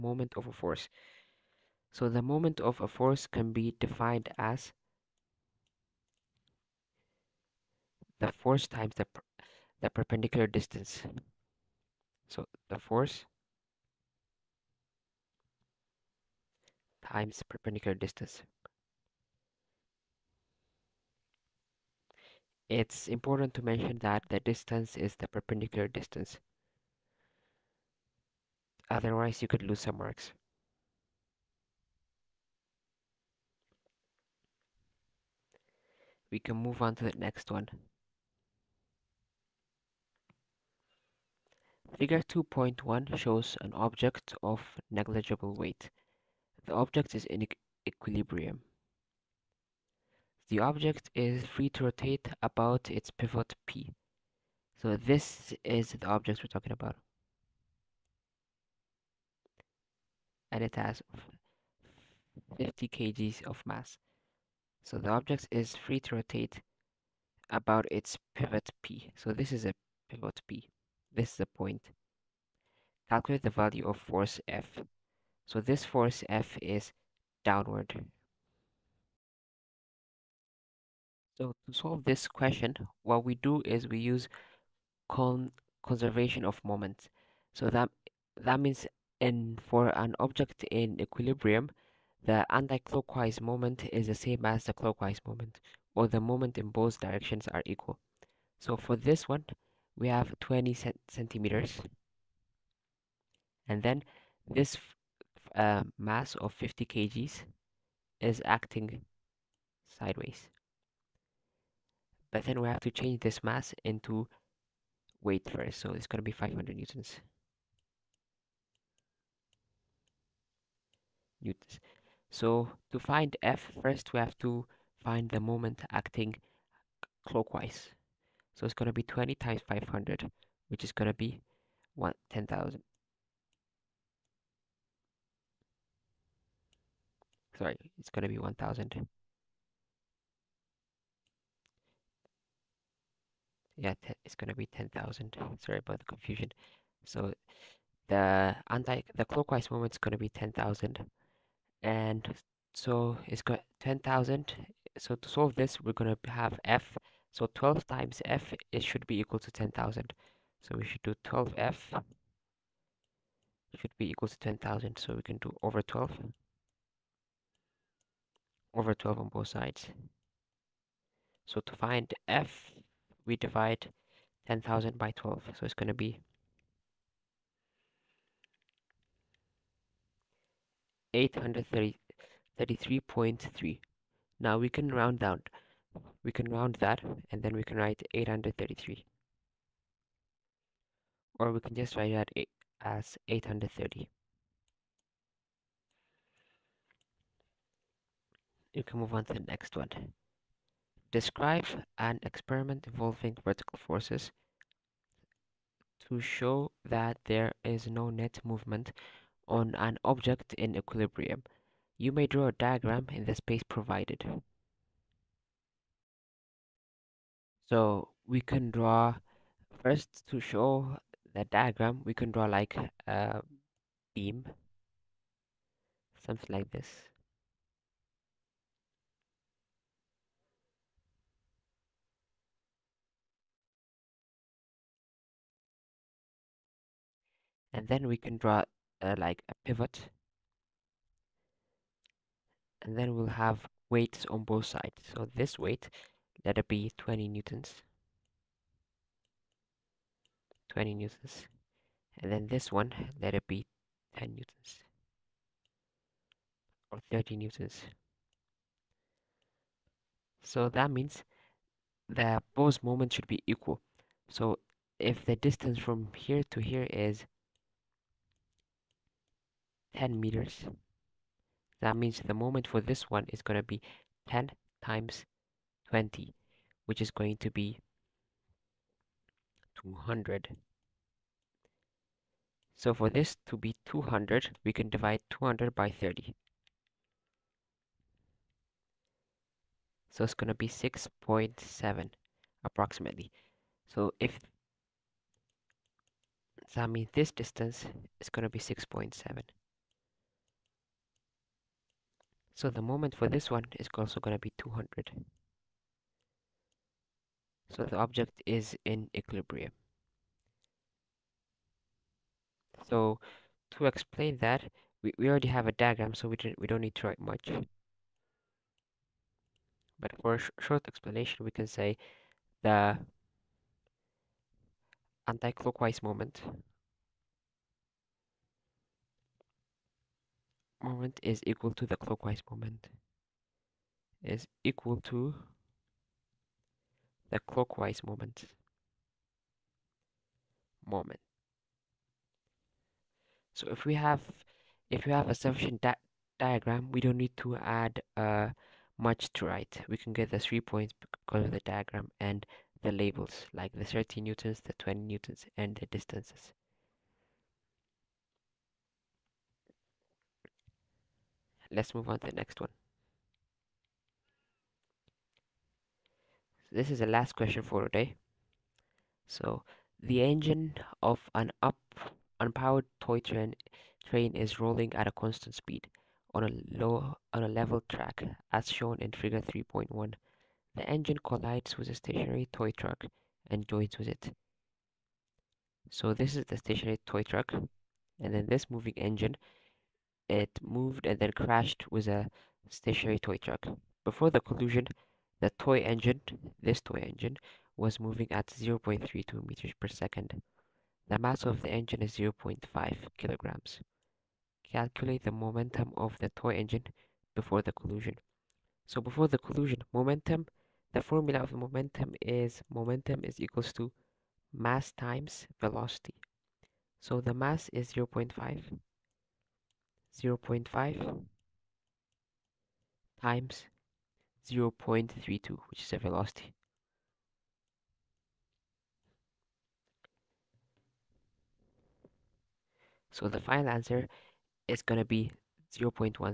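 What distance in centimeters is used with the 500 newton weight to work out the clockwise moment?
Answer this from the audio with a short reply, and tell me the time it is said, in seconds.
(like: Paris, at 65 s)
20 centimeters, at 100 s.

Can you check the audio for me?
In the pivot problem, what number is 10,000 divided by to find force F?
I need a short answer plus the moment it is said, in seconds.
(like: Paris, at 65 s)
12, at 173 s.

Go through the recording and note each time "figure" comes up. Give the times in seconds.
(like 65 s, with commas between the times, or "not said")
41 s, 379 s.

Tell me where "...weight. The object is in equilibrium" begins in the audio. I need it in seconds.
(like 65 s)
45 s.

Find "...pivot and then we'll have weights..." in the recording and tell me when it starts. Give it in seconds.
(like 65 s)
239 s.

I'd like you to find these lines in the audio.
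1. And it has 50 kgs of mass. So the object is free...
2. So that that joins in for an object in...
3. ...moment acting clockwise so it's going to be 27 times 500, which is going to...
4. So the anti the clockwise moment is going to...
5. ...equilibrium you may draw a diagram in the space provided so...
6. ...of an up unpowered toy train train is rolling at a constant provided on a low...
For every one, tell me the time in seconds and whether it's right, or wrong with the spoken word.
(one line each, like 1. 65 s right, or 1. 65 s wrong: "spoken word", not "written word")
1. 60 s right
2. 87 s wrong: "means", not "joins"
3. 125 s wrong: "20", not "27"
4. 147 s right
5. 210 s right
6. 371 s wrong: "speed", not "provided".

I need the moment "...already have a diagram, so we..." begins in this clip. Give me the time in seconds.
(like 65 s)
315 s.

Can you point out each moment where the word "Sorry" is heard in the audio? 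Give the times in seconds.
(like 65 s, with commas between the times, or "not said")
137 s, 145 s.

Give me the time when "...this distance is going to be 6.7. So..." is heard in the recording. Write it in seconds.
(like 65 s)
297 s.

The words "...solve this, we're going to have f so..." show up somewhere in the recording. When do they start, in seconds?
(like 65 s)
155 s.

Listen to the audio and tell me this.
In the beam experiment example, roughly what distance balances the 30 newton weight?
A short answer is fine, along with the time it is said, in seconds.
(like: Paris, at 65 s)
6.7, at 290 s.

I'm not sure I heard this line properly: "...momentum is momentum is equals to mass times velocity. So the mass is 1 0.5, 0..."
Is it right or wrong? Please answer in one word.
wrong.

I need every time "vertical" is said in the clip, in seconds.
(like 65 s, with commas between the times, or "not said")
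203 s.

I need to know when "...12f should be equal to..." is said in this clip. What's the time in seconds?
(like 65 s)
161 s.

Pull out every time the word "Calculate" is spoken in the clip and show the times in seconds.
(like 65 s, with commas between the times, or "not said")
73 s, 404 s.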